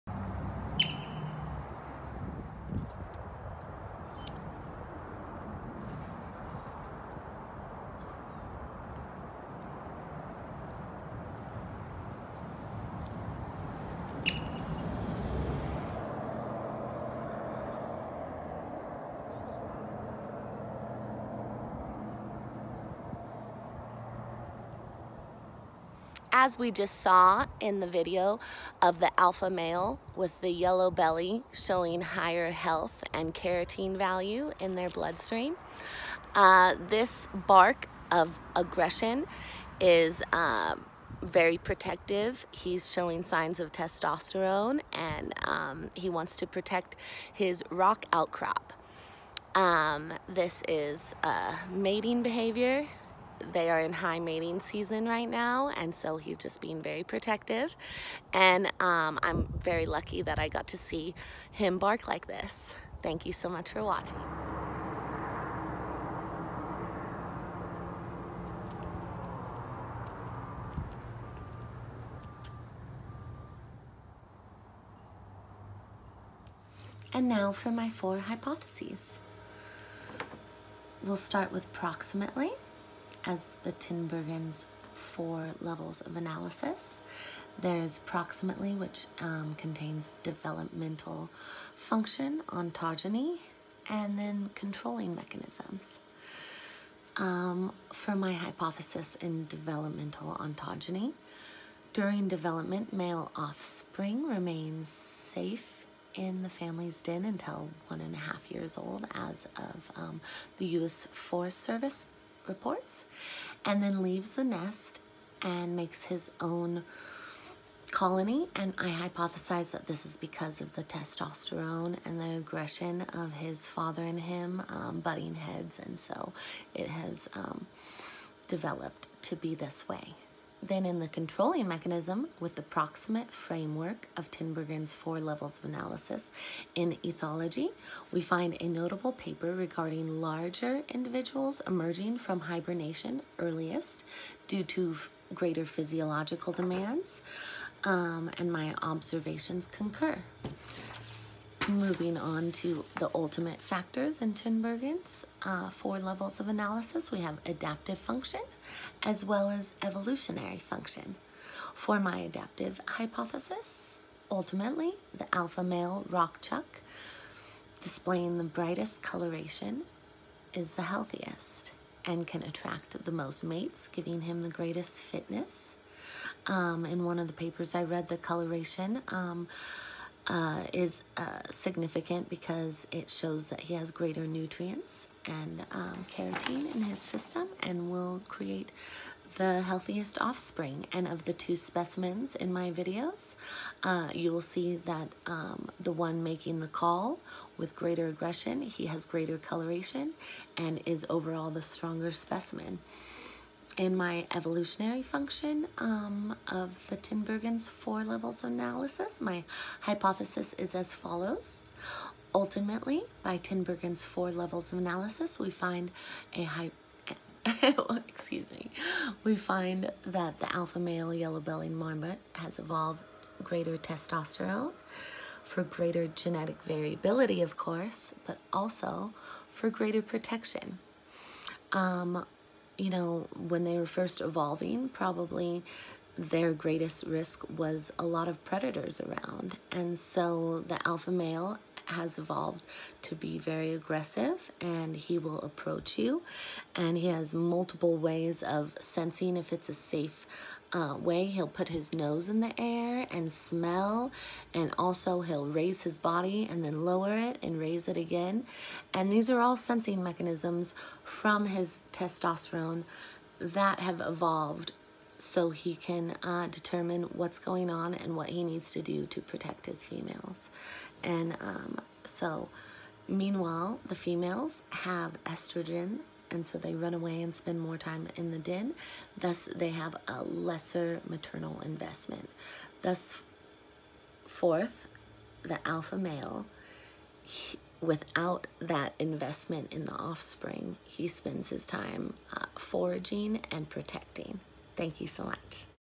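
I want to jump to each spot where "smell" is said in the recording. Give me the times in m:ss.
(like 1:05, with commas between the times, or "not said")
4:13.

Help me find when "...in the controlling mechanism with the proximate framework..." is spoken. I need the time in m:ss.
2:10.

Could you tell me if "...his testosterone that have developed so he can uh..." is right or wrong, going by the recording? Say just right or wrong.
wrong.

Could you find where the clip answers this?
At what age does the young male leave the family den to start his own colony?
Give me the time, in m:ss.
1:47.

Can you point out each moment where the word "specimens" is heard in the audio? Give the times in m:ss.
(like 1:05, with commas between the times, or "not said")
3:11, 3:22.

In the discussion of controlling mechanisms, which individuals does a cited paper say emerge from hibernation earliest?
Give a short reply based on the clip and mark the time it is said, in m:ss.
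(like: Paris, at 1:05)
larger individuals, at 2:20.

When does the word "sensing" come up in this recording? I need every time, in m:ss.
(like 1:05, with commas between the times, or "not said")
4:08, 4:19.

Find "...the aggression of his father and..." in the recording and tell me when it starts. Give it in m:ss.
2:02.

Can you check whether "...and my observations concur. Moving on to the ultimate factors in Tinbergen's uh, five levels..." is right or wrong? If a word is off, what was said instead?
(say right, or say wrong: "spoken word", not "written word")
wrong: "four", not "five".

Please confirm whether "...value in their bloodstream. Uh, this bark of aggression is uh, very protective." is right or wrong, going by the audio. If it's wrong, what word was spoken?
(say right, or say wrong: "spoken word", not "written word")
right.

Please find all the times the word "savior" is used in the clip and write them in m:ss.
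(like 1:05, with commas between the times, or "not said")
not said.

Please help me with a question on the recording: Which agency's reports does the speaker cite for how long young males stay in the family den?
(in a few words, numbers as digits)
U.S. Forest Service.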